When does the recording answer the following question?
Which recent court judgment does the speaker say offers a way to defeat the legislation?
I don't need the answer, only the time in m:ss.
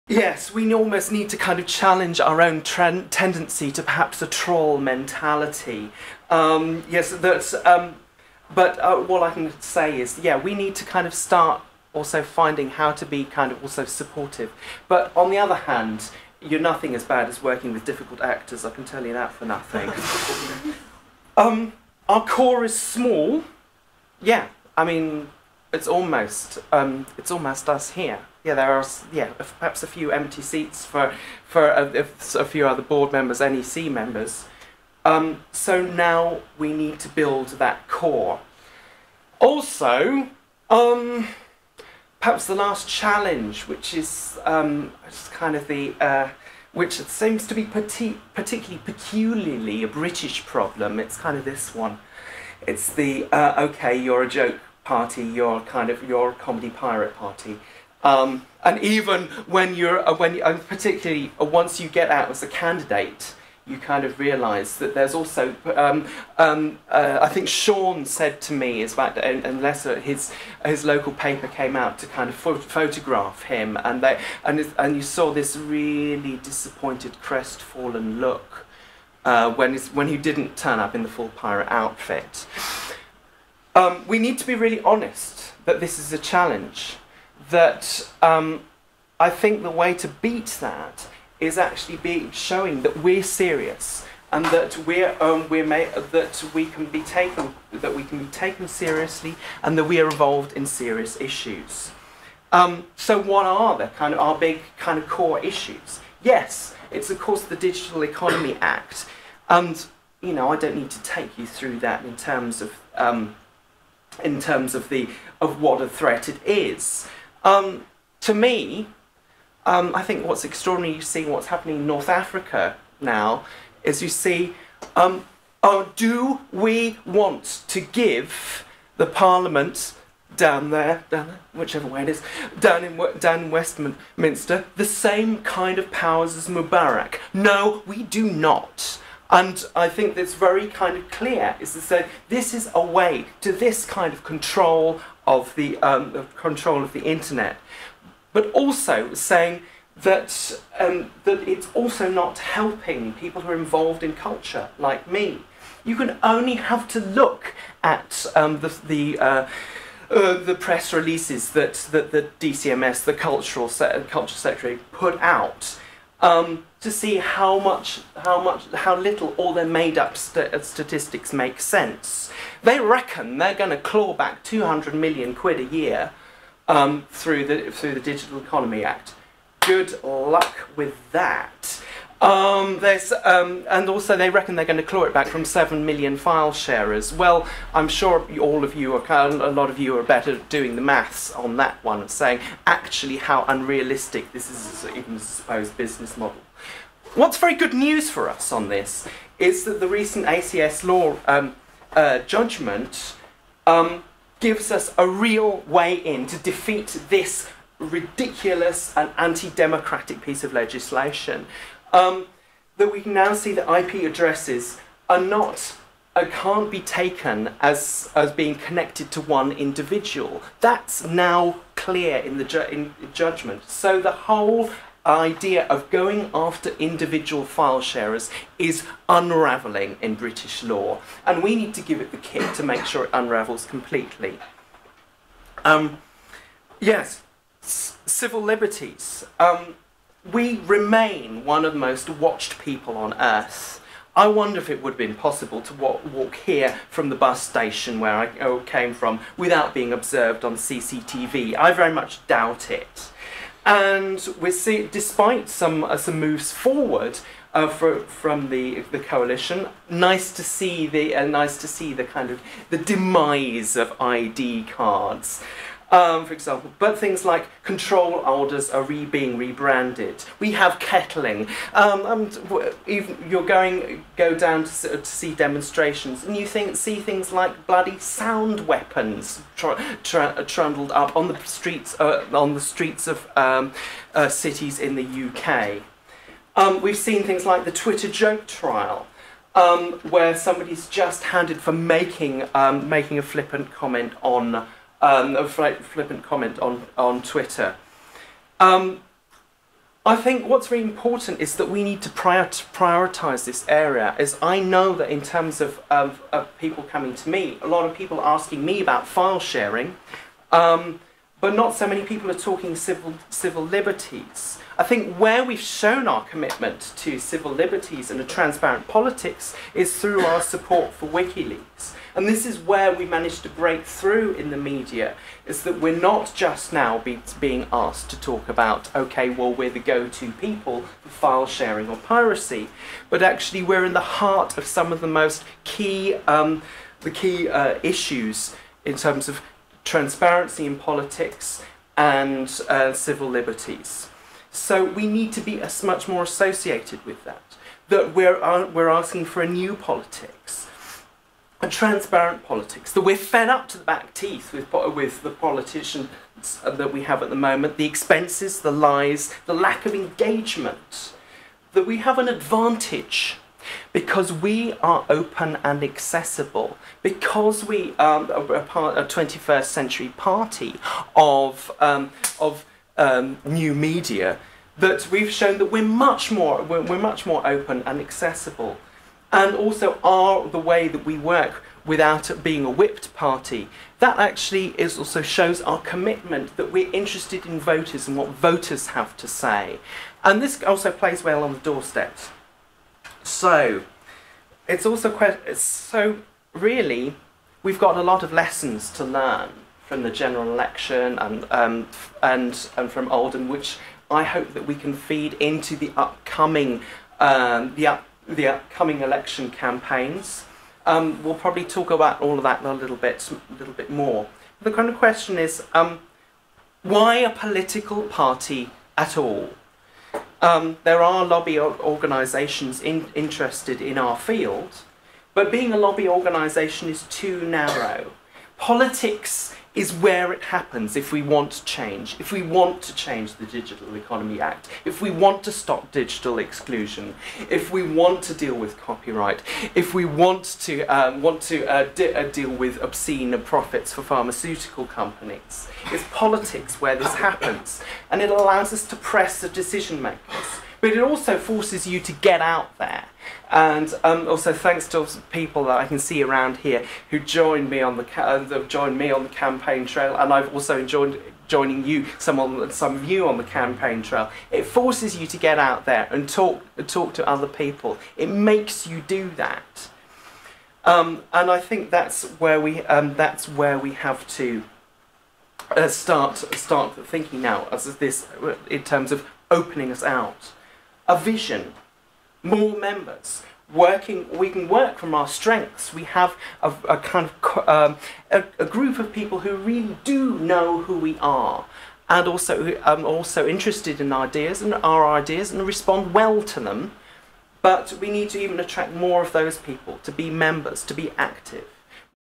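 3:20.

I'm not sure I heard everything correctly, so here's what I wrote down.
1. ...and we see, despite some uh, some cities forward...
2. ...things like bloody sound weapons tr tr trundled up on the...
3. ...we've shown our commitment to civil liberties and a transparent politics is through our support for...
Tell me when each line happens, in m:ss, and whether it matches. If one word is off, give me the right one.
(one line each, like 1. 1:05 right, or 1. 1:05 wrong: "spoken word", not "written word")
1. 4:13 wrong: "moves", not "cities"
2. 4:36 right
3. 5:15 right.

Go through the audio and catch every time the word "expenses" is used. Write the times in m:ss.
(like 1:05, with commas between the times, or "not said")
5:57.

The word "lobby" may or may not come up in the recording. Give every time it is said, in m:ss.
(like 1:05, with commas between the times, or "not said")
7:01, 7:05.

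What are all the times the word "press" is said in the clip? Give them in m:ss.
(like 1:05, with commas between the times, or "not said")
2:40, 7:28.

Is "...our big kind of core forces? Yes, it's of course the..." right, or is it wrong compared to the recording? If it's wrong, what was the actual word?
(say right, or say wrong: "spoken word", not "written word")
wrong: "issues", not "forces".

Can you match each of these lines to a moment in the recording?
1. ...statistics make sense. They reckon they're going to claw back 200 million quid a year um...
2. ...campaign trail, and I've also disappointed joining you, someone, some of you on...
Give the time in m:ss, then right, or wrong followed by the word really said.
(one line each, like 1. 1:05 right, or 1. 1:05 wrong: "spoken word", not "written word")
1. 2:50 right
2. 7:39 wrong: "joined", not "disappointed".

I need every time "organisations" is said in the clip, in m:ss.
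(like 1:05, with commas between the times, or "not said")
7:01, 7:06.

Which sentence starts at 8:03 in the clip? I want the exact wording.
Working, we can work from our strengths.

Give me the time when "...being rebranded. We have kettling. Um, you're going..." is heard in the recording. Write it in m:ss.
4:29.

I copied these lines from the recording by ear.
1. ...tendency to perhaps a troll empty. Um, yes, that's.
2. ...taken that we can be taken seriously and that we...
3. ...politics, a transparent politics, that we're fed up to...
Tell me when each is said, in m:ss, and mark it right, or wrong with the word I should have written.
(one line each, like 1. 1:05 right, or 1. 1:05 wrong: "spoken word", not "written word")
1. 0:02 wrong: "mentality", not "empty"
2. 1:37 right
3. 5:49 right.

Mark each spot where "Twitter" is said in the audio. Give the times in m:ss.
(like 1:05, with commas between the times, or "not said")
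4:47, 4:57.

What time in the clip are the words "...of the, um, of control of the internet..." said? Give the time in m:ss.
2:25.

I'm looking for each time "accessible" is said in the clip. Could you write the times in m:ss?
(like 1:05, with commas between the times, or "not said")
6:05, 6:17.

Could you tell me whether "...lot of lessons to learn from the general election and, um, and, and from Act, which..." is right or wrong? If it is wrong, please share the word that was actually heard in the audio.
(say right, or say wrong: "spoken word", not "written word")
wrong: "Oldham", not "Act".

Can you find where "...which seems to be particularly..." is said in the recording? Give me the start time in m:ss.
0:46.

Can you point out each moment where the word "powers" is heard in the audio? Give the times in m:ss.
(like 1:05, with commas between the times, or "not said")
2:15.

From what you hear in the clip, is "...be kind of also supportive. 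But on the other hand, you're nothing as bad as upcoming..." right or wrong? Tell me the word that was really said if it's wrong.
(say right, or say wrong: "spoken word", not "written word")
wrong: "working", not "upcoming".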